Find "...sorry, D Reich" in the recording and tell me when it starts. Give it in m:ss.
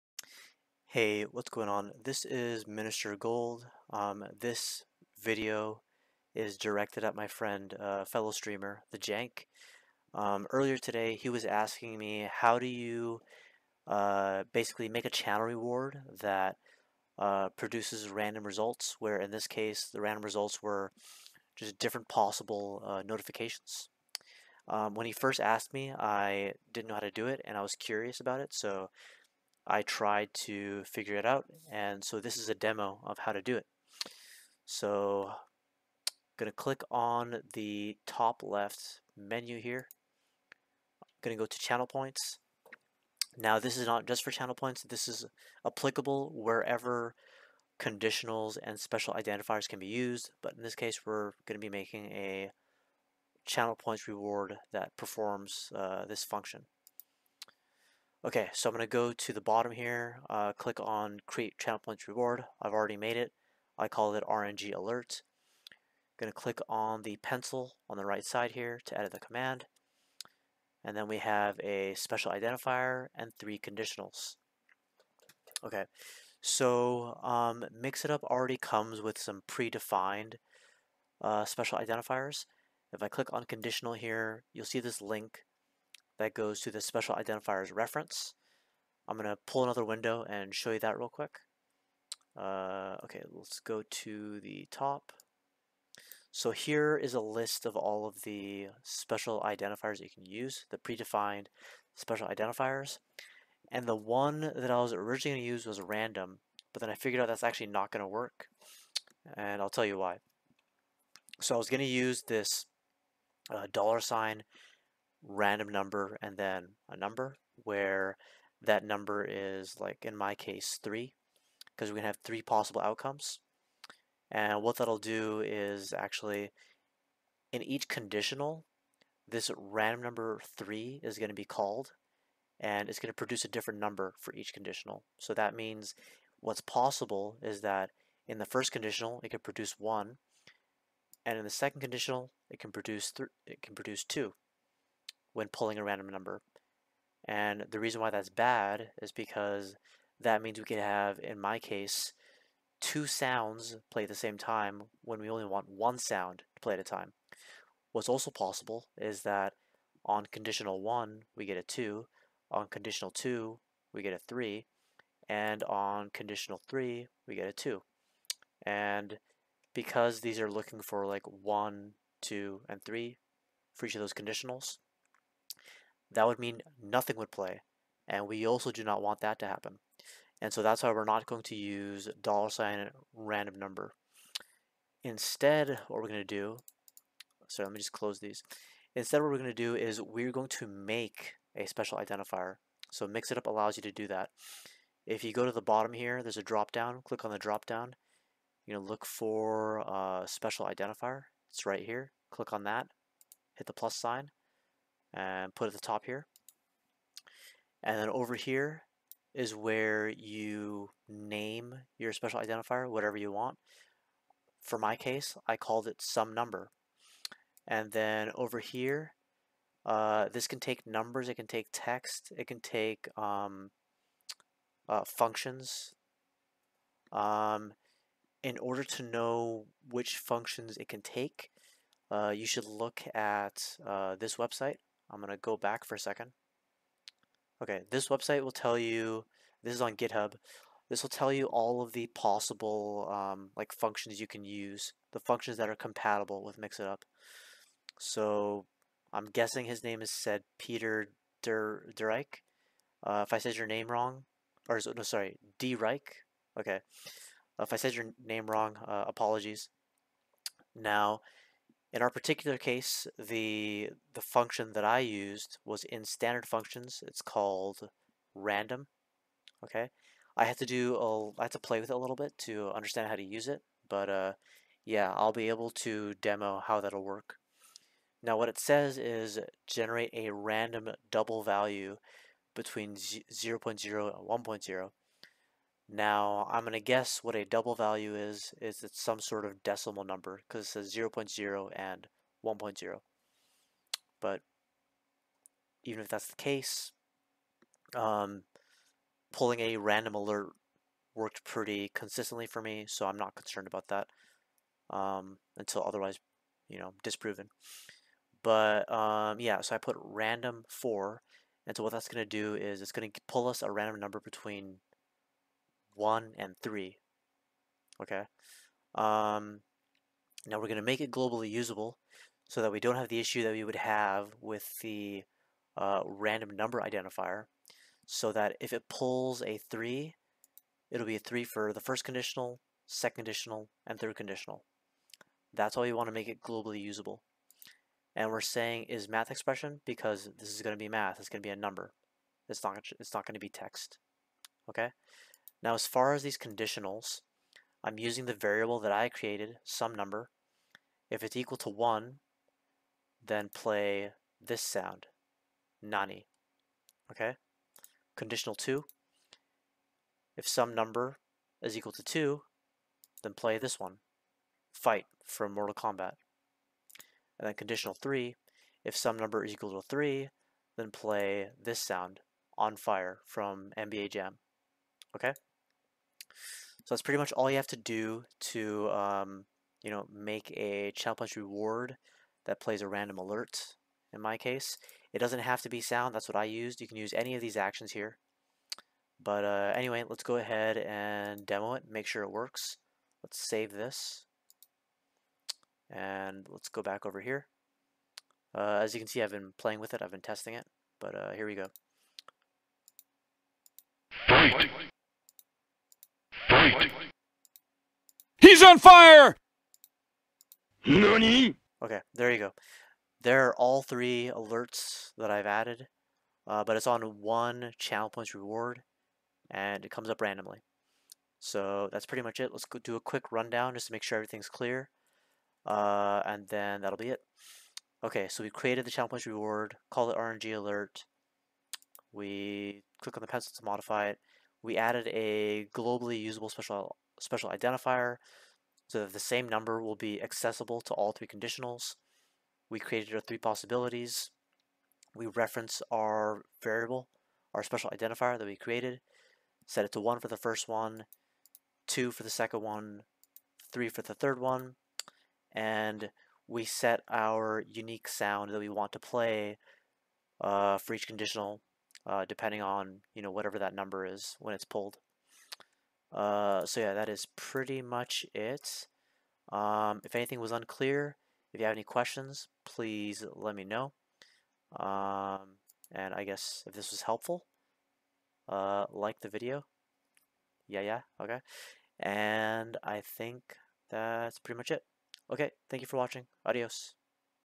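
4:15.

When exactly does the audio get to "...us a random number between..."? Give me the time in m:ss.
5:13.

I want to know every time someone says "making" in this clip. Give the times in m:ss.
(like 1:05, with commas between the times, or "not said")
0:51.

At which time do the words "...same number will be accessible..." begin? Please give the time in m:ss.
7:19.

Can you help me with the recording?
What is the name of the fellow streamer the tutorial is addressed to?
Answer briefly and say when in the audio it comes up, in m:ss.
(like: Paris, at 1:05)
The Jank, at 0:08.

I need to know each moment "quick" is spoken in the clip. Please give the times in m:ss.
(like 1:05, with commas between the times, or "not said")
1:31, 7:02.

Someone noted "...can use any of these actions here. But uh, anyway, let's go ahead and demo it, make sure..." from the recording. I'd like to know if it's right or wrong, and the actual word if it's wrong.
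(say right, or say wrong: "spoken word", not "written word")
right.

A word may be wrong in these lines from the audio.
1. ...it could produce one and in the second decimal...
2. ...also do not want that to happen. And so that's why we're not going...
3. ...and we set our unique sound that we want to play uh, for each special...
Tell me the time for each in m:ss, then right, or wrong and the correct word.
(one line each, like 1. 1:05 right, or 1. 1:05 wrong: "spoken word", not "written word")
1. 2:19 wrong: "conditional", not "decimal"
2. 2:58 right
3. 7:35 wrong: "conditional", not "special".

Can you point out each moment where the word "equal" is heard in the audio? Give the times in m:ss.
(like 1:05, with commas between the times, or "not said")
5:51, 6:01, 6:09.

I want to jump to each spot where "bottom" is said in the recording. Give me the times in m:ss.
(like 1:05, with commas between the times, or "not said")
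0:59, 3:15.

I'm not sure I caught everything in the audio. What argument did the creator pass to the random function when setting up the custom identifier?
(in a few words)
4.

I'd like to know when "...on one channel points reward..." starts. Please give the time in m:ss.
6:56.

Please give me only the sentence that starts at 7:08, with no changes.
Okay, so we created the channel points reward, call it RNG alert.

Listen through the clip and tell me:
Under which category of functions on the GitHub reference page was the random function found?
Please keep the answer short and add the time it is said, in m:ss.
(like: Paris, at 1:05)
standard functions, at 4:26.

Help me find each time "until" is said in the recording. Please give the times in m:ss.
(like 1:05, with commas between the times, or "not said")
5:05.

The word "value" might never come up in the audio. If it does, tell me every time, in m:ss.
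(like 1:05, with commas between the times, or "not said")
4:41, 4:47.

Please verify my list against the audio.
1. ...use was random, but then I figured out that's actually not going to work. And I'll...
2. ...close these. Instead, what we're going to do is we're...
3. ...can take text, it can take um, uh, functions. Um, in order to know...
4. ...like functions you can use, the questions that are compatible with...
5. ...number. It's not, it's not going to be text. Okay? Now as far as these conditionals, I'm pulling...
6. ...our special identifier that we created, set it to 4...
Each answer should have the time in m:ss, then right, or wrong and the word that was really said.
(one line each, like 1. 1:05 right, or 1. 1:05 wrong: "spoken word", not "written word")
1. 1:45 right
2. 3:07 right
3. 3:41 right
4. 4:03 wrong: "functions", not "questions"
5. 5:41 wrong: "using", not "pulling"
6. 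7:27 wrong: "1", not "4".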